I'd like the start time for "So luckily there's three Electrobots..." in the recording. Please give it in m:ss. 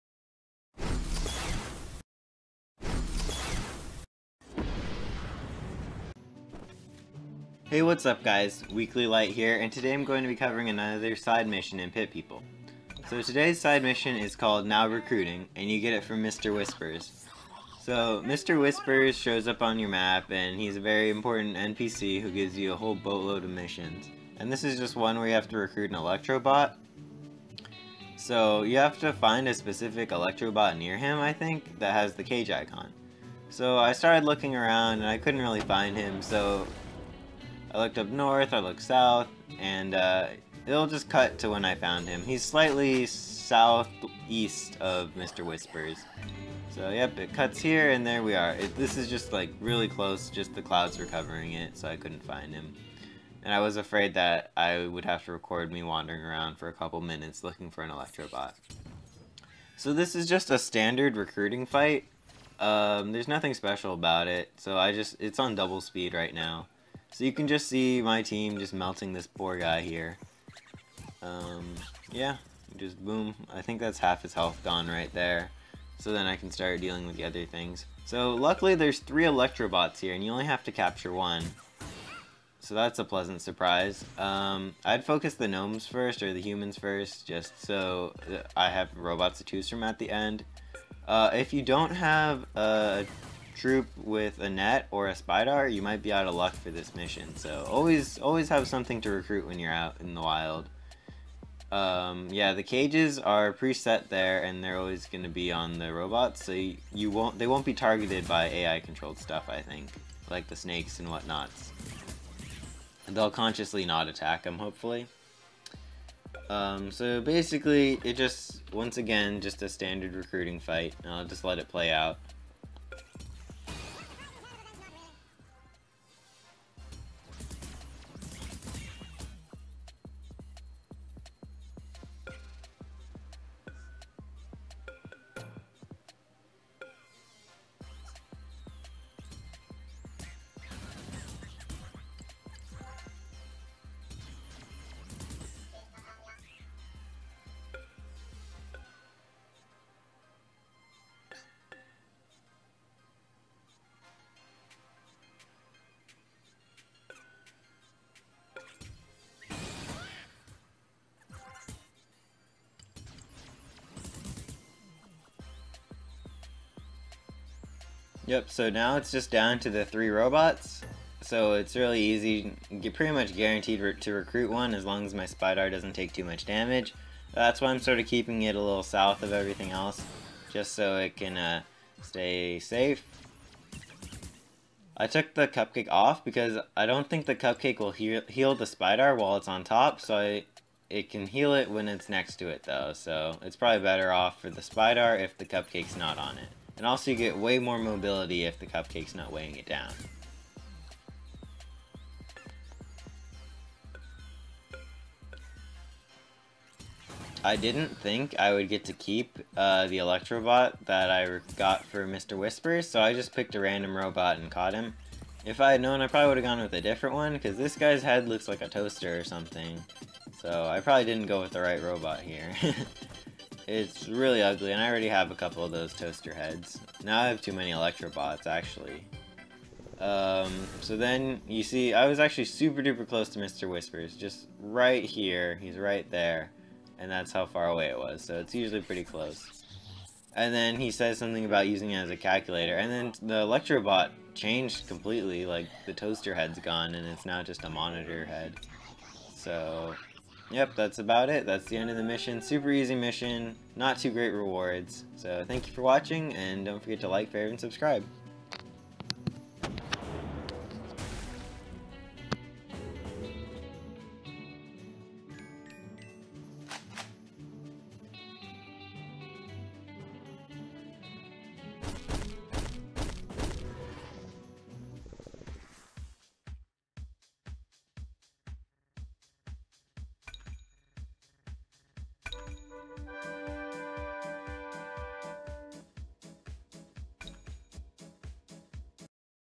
1:18.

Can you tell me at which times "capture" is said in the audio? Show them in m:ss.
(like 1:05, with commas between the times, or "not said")
1:20.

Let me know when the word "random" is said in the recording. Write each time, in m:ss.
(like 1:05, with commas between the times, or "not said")
3:33.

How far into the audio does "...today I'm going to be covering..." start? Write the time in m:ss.
0:09.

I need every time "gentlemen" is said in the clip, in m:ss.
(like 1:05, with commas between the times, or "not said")
not said.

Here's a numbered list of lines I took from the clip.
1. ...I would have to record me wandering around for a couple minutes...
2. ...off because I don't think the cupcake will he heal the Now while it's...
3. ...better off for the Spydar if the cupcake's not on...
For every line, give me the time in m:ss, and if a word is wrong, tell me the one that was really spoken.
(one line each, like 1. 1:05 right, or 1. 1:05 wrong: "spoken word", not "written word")
1. 0:54 right
2. 3:05 wrong: "Spydar", not "Now"
3. 3:13 right.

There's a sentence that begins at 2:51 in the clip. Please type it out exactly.
So it's really easy, get pretty much guaranteed re to recruit one as long as my Spydar doesn't take too much damage.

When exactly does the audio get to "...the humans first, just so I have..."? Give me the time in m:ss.
1:26.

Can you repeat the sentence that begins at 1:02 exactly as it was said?
Um, there's nothing special about it, so I just, it's on double speed right now.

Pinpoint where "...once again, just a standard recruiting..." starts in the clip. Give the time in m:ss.
1:58.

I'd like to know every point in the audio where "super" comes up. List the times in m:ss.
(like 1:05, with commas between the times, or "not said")
3:52, 4:12.